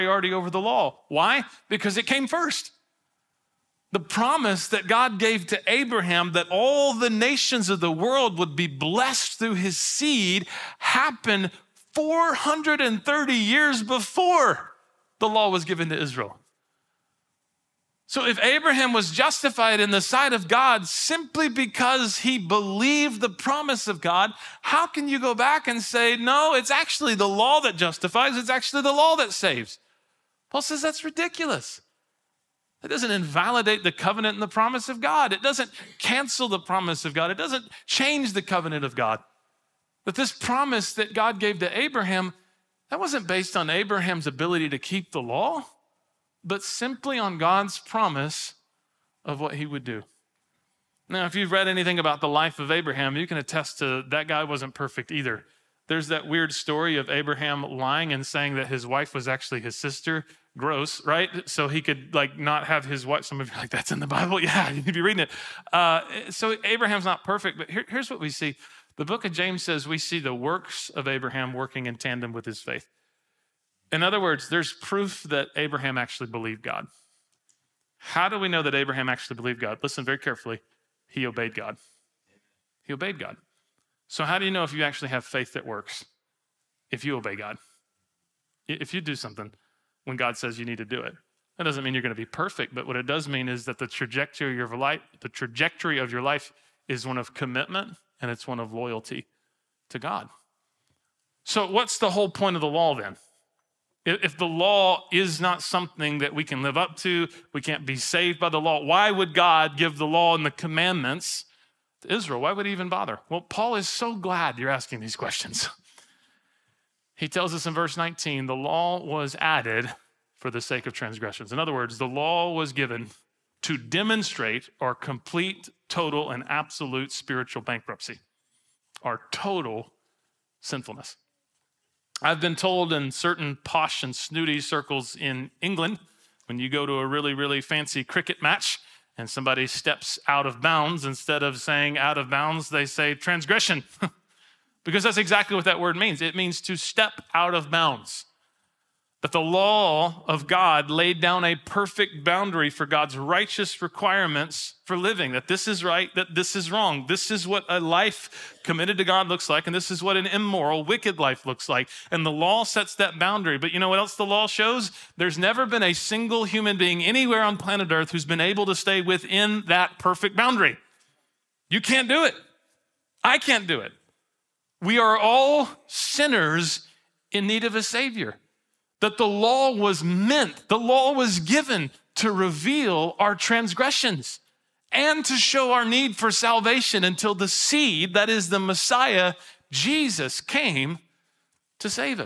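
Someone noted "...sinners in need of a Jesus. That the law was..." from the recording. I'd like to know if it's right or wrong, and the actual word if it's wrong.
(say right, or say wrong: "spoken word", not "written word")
wrong: "Savior", not "Jesus".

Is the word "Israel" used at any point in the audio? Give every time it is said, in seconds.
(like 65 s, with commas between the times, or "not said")
16 s, 112 s.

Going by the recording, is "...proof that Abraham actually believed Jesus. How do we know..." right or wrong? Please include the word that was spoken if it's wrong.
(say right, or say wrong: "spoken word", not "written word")
wrong: "God", not "Jesus".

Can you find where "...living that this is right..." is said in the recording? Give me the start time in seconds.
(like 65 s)
154 s.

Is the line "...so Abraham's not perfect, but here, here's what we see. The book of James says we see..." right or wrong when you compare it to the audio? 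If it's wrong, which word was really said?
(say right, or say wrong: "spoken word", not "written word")
right.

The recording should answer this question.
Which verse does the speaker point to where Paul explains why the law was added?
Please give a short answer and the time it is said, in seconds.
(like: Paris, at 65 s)
Verse 19, at 117 s.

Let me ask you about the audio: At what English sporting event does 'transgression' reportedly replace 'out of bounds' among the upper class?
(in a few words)
Cricket match.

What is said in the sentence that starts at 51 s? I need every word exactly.
Now, if you've read anything about the life of Abraham, you can attest to that guy wasn't perfect either.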